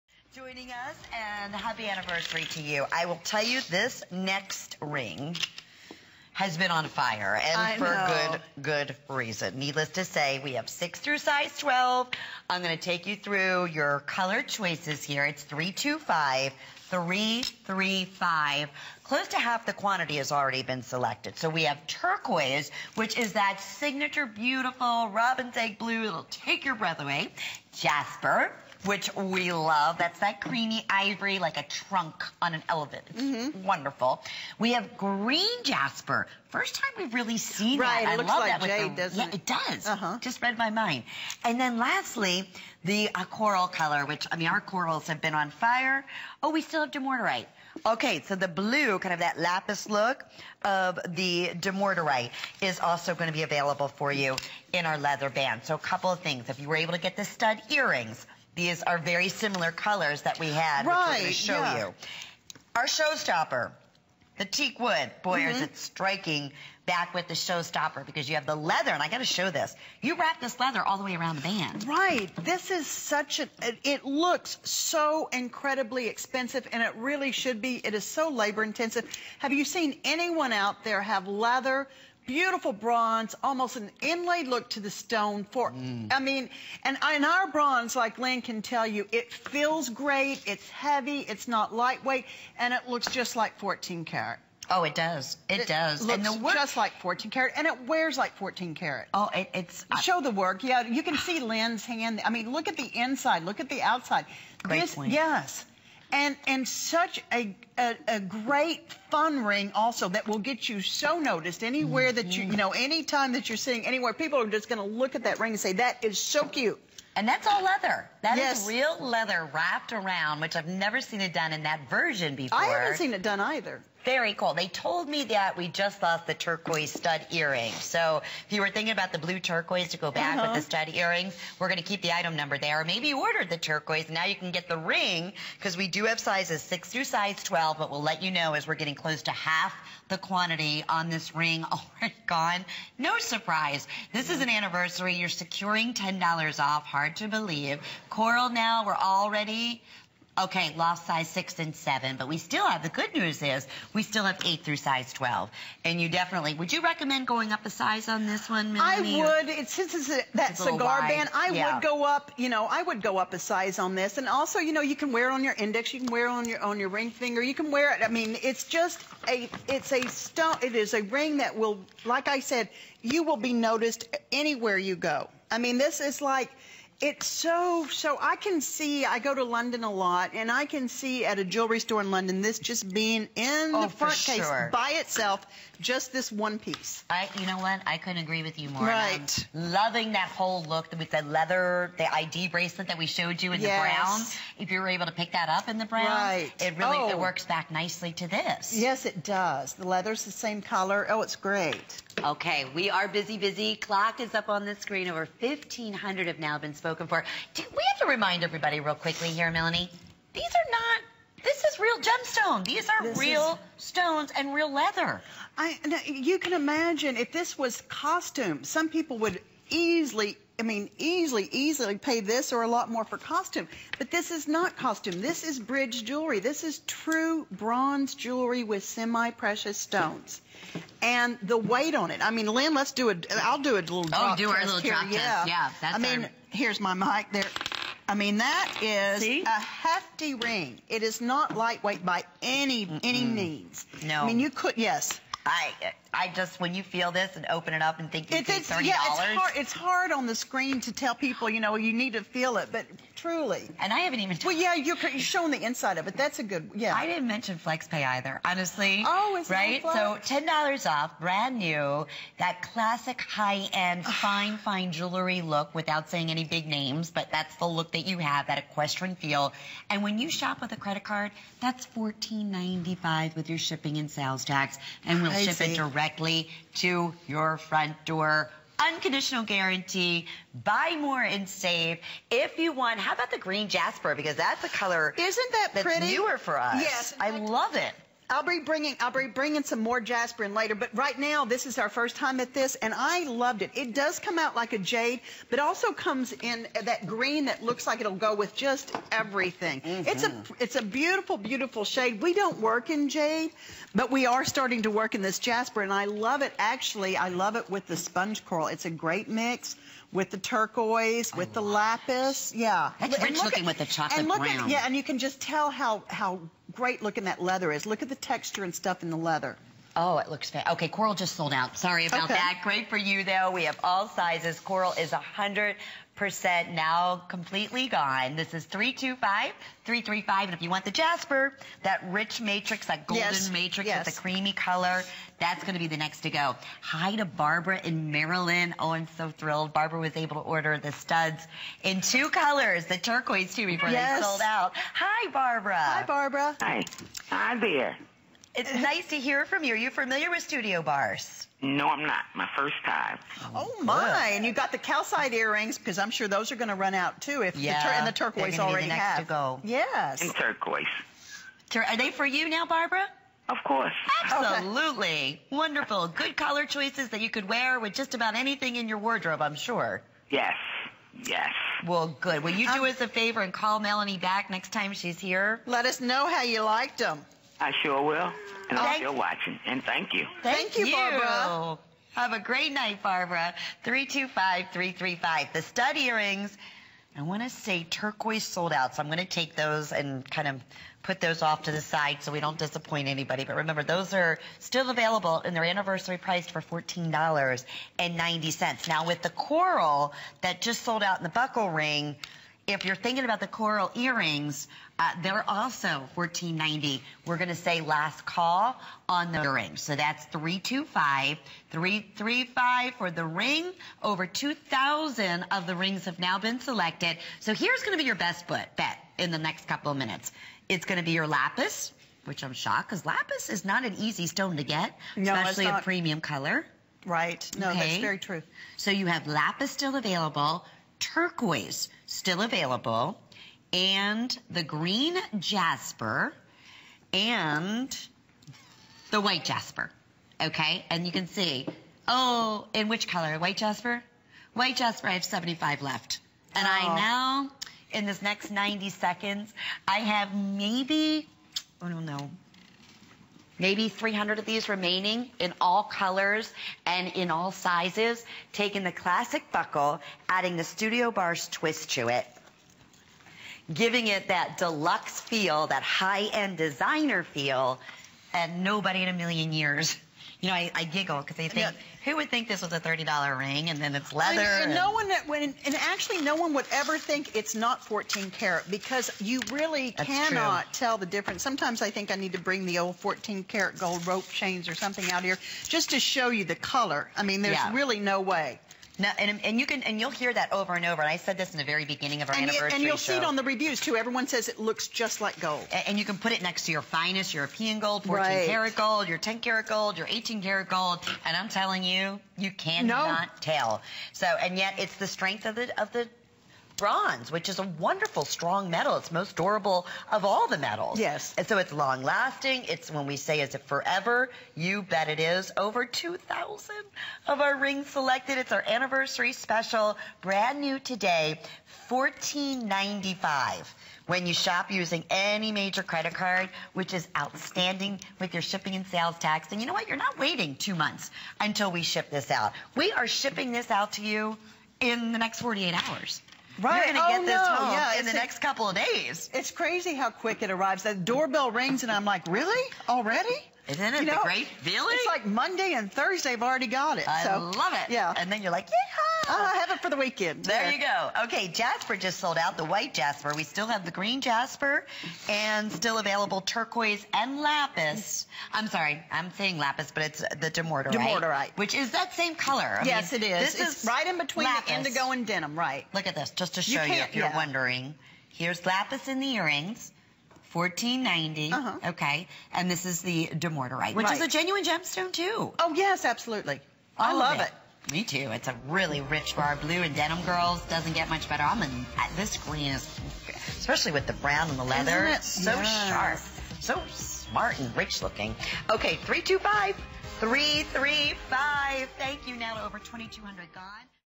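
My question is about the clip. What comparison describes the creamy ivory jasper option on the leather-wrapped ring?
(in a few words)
a trunk on an elephant.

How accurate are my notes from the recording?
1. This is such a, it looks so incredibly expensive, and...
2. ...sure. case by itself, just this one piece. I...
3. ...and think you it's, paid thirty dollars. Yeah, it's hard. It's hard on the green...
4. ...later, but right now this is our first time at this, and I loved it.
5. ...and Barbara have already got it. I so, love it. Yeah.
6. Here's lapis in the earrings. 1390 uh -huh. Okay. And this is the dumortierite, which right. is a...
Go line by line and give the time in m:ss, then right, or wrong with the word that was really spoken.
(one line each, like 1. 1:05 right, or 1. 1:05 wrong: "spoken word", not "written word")
1. 1:12 right
2. 3:04 right
3. 4:07 wrong: "screen", not "green"
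4. 4:50 right
5. 9:05 wrong: "Thursday", not "Barbara"
6. 9:28 wrong: "1490", not "1390".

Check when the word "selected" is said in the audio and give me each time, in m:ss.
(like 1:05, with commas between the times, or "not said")
0:20, 6:56, 8:37.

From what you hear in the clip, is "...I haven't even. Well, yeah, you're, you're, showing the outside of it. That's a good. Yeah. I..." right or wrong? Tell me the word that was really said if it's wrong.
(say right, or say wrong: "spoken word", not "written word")
wrong: "inside", not "outside".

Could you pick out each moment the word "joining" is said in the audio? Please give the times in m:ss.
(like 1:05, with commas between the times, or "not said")
0:00.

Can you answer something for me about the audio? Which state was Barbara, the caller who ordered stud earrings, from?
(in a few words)
Maryland.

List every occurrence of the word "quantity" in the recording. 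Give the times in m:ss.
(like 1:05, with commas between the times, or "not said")
0:19, 2:20.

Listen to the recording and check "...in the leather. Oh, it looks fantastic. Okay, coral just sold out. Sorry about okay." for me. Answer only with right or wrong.
right.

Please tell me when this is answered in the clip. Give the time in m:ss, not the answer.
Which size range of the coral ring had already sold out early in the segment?
2:31.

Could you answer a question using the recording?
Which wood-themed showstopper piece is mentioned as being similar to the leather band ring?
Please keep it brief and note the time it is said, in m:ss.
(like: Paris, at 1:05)
teak wood, at 1:04.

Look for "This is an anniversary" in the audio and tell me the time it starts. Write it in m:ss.
2:24.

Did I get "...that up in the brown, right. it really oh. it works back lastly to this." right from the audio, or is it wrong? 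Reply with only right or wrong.
wrong.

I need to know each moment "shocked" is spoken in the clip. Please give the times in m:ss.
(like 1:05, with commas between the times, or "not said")
7:02.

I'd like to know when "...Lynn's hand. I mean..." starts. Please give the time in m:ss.
1:41.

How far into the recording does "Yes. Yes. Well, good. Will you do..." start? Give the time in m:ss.
6:10.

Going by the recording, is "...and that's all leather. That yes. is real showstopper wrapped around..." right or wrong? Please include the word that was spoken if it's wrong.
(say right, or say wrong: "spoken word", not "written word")
wrong: "leather", not "showstopper".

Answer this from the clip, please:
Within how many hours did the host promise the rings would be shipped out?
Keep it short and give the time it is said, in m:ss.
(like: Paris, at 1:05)
48 hours, at 8:55.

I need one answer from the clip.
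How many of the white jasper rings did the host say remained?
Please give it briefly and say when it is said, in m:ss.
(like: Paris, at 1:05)
75, at 7:25.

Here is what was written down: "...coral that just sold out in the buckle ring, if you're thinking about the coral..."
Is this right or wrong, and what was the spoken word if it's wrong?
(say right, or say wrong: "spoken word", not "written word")
right.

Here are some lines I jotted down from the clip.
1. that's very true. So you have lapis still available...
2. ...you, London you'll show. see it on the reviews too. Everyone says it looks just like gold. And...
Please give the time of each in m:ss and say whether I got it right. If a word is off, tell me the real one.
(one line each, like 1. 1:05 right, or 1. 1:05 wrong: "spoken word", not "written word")
1. 7:07 right
2. 8:12 wrong: "And", not "London".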